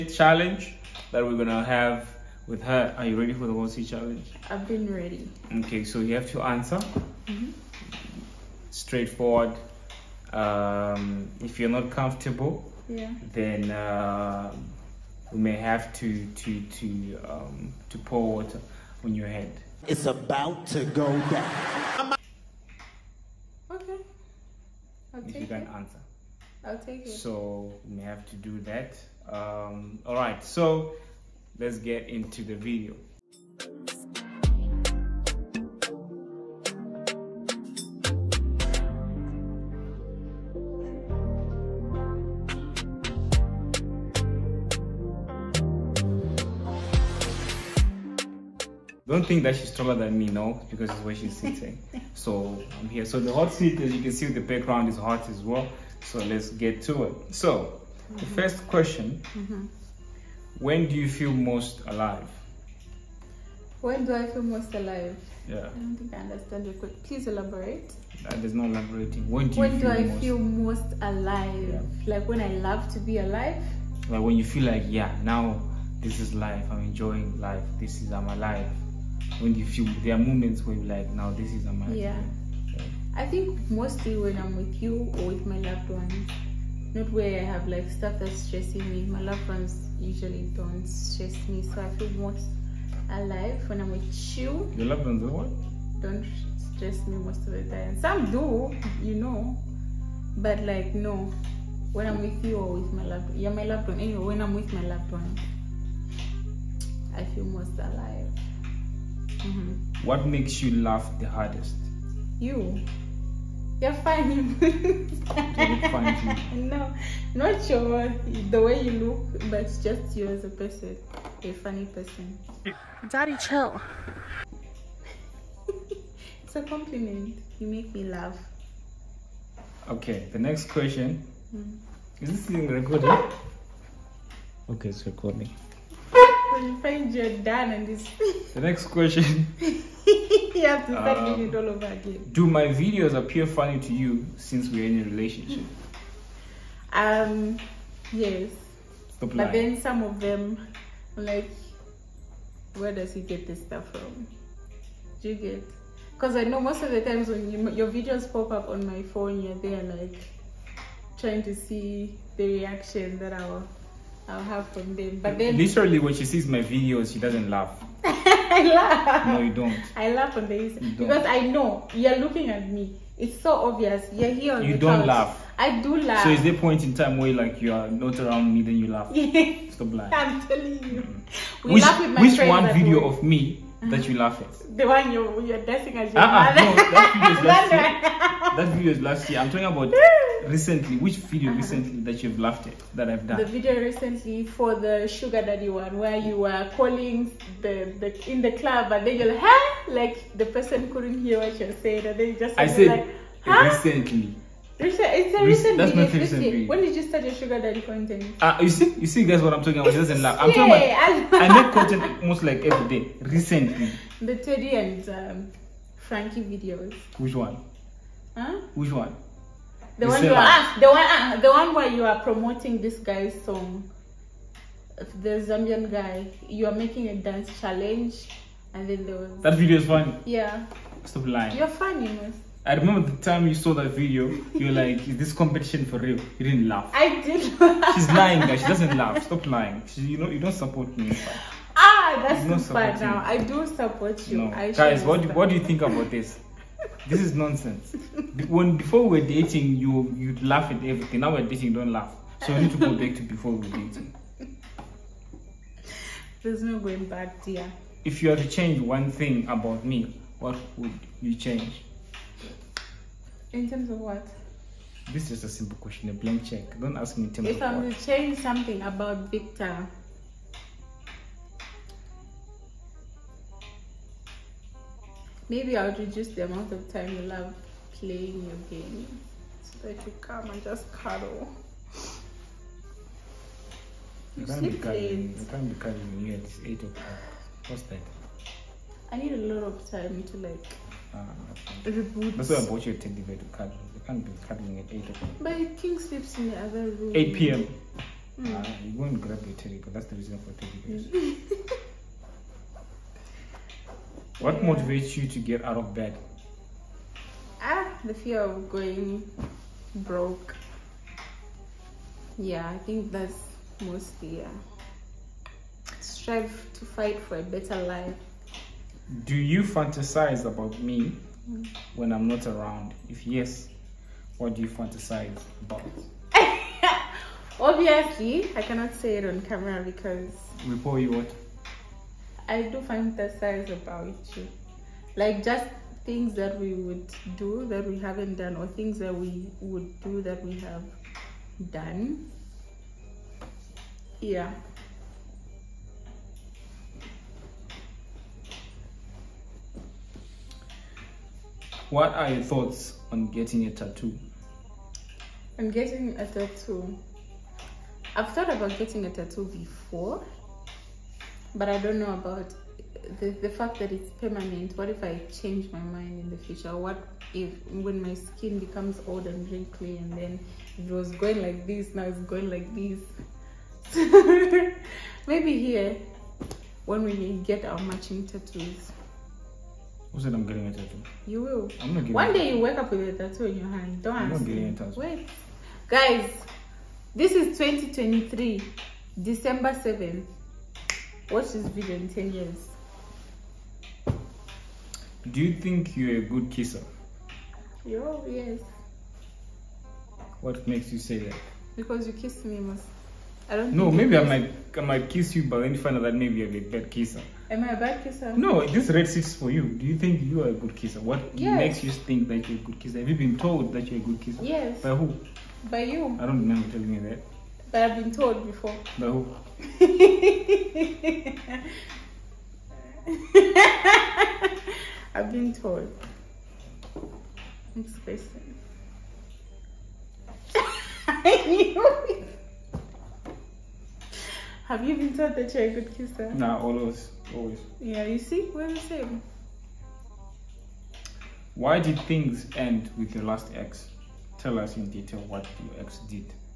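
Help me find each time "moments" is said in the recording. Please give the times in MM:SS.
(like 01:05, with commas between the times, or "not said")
01:20.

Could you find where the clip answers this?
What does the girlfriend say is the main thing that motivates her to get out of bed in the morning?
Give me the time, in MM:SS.
05:08.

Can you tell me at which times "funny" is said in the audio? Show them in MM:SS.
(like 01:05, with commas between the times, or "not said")
01:53, 02:01, 02:23, 03:51.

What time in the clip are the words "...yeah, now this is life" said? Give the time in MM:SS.
01:14.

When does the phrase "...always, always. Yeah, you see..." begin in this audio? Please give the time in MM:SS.
07:16.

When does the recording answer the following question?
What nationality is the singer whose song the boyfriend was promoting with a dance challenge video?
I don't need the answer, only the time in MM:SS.
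03:45.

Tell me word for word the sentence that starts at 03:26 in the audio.
When did you start your sugar daddy content?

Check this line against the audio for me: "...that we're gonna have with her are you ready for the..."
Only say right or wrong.
right.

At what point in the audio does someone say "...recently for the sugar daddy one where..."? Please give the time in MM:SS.
03:13.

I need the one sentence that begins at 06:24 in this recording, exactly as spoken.
Don't I'm not getting a tattoo.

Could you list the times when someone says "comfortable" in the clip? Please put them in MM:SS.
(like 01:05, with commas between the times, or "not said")
00:11.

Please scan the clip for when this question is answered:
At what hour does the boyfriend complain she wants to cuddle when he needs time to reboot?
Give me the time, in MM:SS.
04:57.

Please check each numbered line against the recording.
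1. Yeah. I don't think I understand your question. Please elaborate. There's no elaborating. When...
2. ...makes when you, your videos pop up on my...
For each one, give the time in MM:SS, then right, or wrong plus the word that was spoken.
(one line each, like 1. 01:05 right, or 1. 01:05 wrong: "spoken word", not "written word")
1. 01:05 right
2. 02:37 wrong: "times", not "makes".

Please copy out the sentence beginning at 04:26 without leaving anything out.
Don't ask me in terms if of I'm what.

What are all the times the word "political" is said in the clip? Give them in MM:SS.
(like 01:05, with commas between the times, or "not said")
not said.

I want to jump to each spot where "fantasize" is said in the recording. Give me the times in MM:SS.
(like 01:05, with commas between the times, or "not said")
05:19, 05:24, 05:32.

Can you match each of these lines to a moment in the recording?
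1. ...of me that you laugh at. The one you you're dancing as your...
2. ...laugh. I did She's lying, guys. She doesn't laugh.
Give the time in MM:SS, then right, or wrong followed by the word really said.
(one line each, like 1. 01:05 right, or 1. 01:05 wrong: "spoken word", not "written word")
1. 03:03 right
2. 03:56 right.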